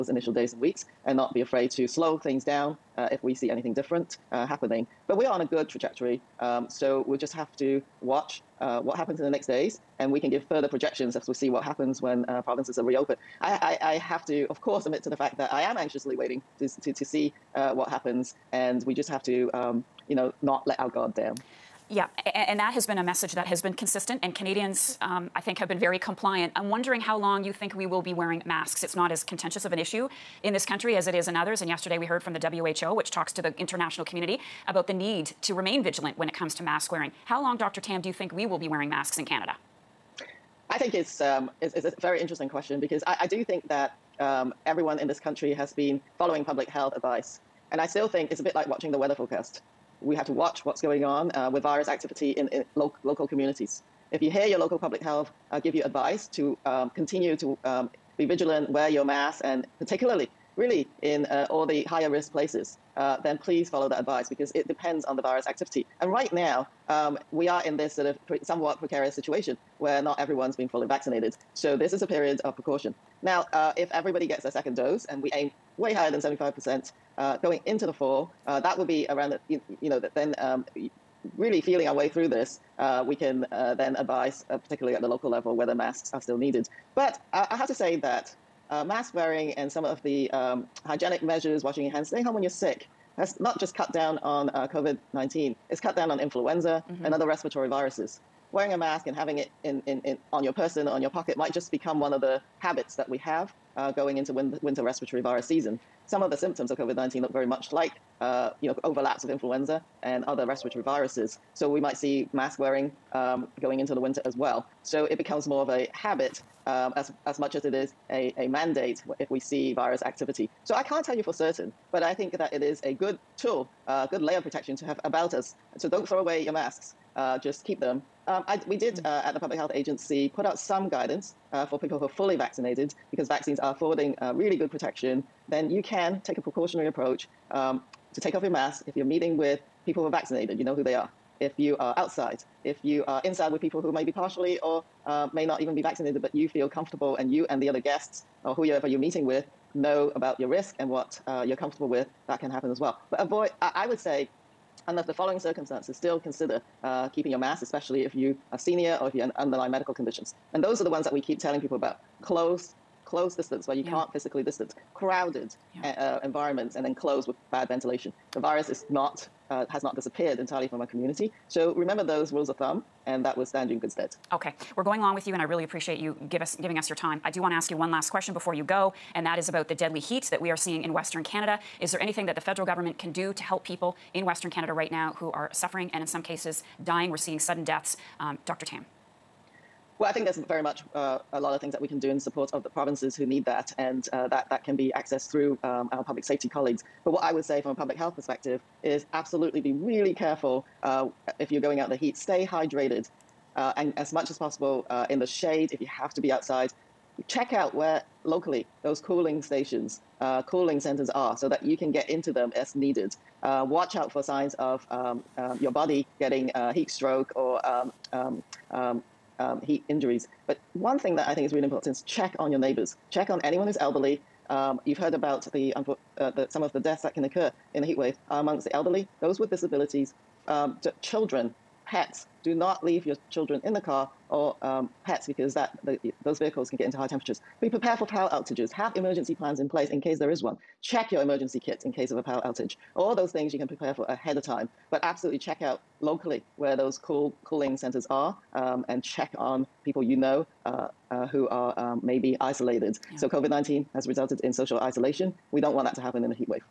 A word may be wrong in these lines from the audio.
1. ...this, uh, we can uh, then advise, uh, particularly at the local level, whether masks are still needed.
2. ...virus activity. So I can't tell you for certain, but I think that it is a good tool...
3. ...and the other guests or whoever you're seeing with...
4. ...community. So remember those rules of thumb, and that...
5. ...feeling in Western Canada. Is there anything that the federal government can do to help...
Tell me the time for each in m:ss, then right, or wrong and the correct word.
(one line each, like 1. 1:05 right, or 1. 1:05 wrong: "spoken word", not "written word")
1. 1:22 right
2. 1:59 right
3. 2:27 wrong: "meeting", not "seeing"
4. 2:50 right
5. 3:00 wrong: "seeing", not "feeling".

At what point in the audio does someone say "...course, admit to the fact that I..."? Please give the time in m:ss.
0:14.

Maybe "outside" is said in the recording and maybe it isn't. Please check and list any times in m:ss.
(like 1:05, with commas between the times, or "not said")
2:21, 3:26.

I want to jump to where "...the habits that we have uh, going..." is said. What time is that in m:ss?
1:42.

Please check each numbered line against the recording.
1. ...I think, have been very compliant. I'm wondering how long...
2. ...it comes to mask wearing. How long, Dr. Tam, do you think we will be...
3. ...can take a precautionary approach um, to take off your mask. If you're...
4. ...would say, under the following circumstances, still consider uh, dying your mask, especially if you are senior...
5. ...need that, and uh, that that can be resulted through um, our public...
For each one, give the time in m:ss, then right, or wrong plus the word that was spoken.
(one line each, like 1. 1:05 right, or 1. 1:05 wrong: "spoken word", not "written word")
1. 0:25 right
2. 0:36 right
3. 2:15 right
4. 2:33 wrong: "keeping", not "dying"
5. 3:13 wrong: "accessed", not "resulted".